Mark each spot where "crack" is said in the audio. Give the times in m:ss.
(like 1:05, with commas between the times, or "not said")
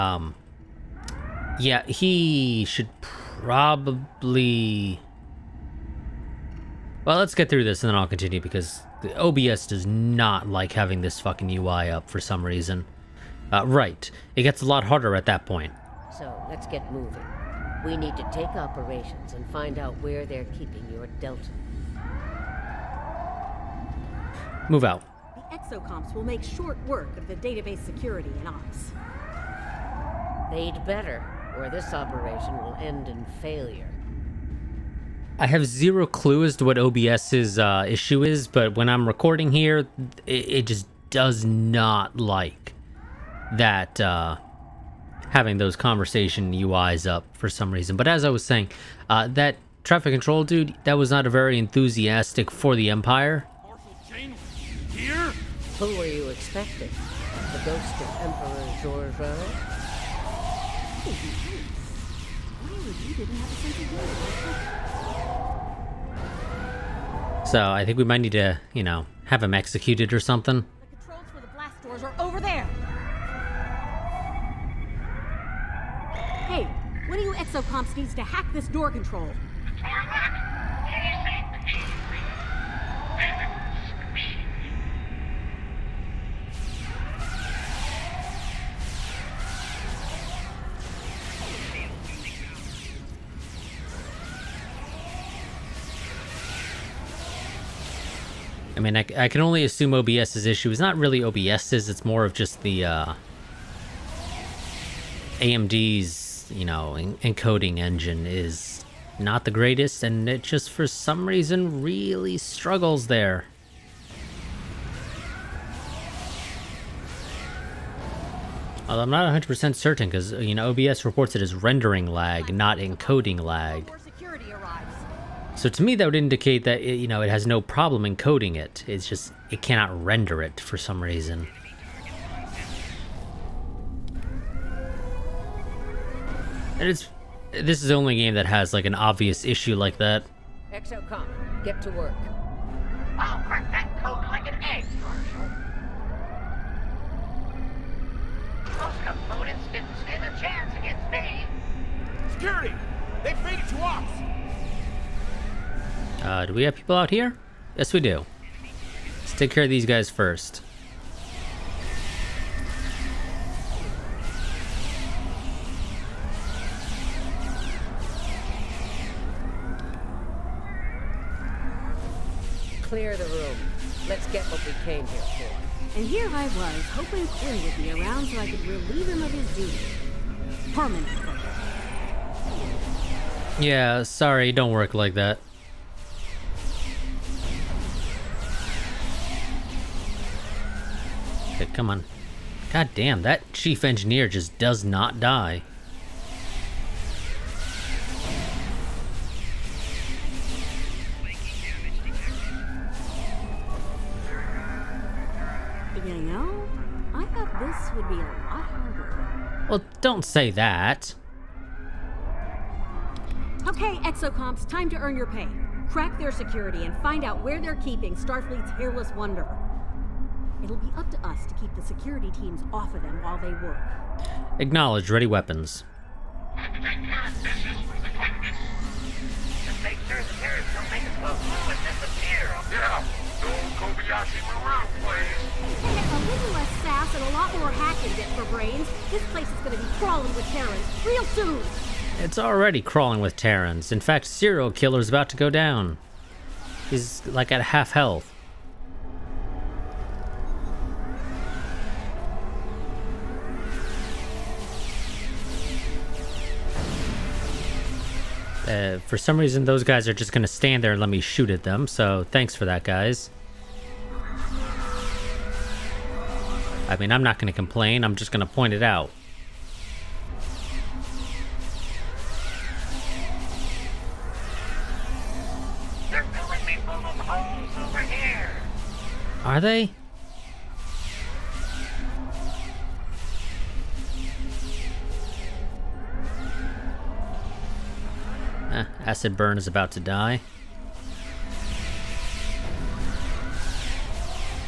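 2:23, 3:35.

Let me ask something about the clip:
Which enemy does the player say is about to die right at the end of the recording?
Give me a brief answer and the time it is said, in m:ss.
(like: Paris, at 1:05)
Acid Burn, at 4:49.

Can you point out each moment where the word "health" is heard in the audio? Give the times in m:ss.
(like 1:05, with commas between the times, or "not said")
4:07.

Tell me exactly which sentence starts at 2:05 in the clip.
So to me, that would indicate that it, you know it has no problem encoding it.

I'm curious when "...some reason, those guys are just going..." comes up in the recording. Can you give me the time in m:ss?
4:19.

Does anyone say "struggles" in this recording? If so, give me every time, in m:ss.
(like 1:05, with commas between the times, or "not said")
1:52.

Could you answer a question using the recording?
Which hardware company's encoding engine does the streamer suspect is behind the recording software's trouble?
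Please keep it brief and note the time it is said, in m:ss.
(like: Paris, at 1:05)
AMD, at 1:45.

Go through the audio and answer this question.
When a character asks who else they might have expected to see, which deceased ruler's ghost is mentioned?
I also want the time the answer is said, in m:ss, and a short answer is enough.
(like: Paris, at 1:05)
Emperor Georgiou, at 0:58.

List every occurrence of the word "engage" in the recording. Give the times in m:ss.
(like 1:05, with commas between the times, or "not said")
not said.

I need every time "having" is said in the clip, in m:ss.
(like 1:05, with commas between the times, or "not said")
0:10, 0:45.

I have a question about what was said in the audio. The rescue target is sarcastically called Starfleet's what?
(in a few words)
hairless wonder.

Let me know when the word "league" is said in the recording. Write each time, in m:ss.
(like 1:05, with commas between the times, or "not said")
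not said.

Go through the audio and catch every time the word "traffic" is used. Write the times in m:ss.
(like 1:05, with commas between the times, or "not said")
0:49.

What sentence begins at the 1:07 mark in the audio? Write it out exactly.
So I think we might need to, you know, have him executed or something.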